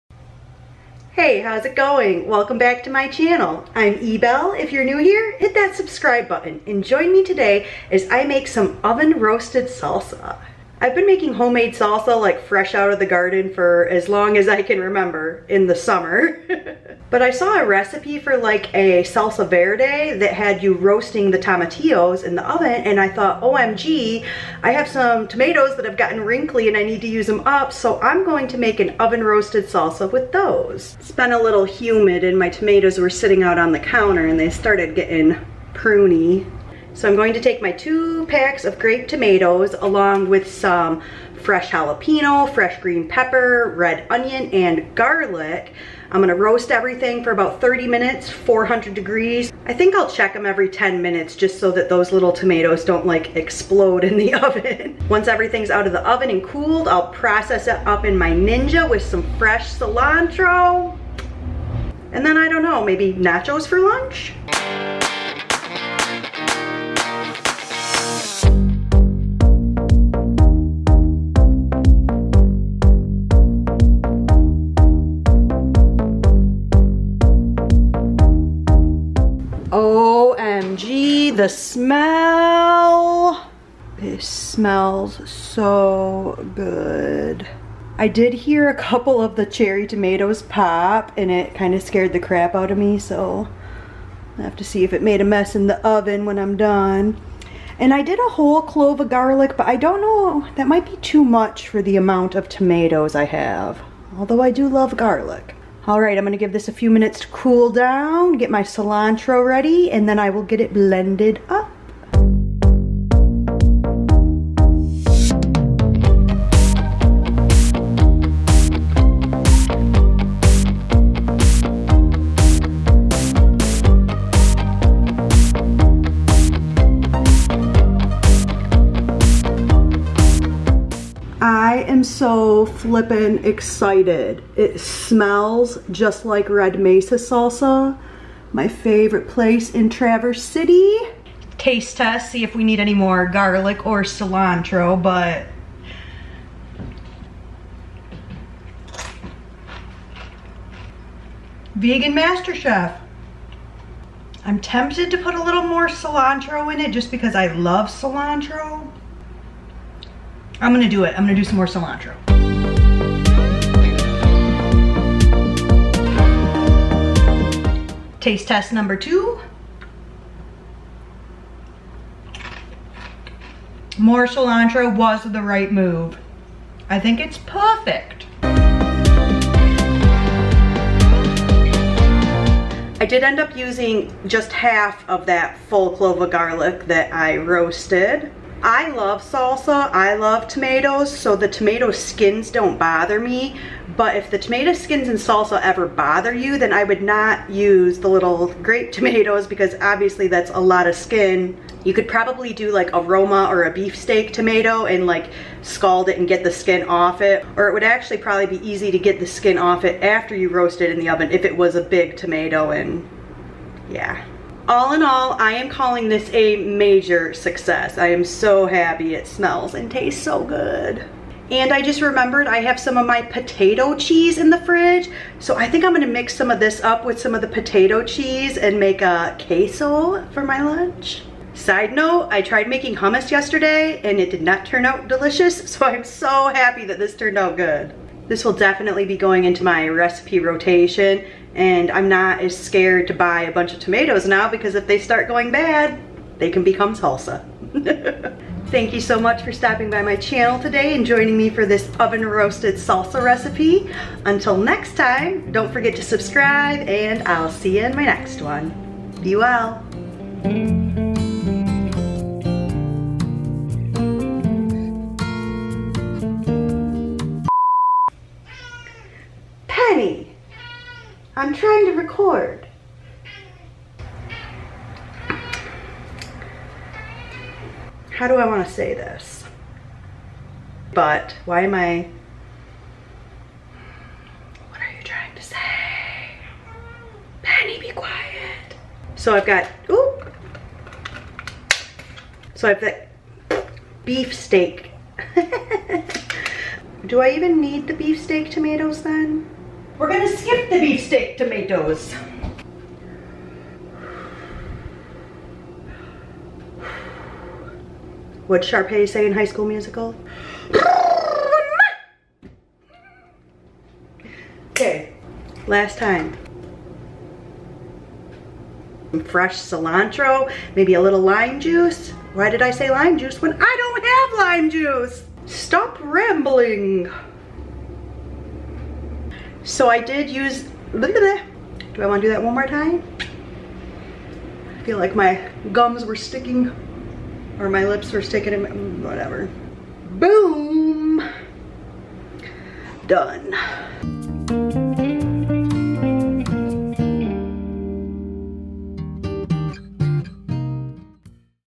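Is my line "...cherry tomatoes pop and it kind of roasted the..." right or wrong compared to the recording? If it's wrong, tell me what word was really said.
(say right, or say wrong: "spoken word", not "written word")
wrong: "scared", not "roasted".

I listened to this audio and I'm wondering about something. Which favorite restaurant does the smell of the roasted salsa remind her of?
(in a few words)
Red Mesa.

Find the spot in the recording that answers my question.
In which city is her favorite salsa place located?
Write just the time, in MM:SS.
02:19.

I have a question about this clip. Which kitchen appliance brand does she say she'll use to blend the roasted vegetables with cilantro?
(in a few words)
Ninja.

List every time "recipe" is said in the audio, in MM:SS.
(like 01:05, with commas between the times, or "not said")
00:17, 03:59, 04:13.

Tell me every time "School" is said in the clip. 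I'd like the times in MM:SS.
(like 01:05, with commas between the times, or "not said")
05:09.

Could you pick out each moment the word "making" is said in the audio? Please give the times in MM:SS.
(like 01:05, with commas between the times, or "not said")
00:11, 03:52.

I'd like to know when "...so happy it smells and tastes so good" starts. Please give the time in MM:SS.
03:38.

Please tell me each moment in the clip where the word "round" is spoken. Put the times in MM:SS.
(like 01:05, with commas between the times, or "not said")
not said.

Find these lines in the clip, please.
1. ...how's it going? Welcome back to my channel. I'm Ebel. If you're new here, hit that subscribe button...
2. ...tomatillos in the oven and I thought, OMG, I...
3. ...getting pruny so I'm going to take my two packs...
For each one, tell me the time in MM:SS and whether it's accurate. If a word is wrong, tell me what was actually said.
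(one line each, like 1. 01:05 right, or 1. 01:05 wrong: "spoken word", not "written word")
1. 00:01 right
2. 00:21 right
3. 00:34 right.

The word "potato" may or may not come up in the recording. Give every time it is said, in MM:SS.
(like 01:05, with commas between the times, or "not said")
03:43, 03:47.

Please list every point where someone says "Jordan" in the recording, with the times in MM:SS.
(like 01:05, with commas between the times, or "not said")
not said.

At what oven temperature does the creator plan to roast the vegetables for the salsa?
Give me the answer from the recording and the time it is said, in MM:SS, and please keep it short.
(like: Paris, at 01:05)
400 degrees, at 00:48.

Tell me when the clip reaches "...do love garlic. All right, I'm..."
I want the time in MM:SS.
01:44.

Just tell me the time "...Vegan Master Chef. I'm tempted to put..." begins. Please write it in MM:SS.
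02:31.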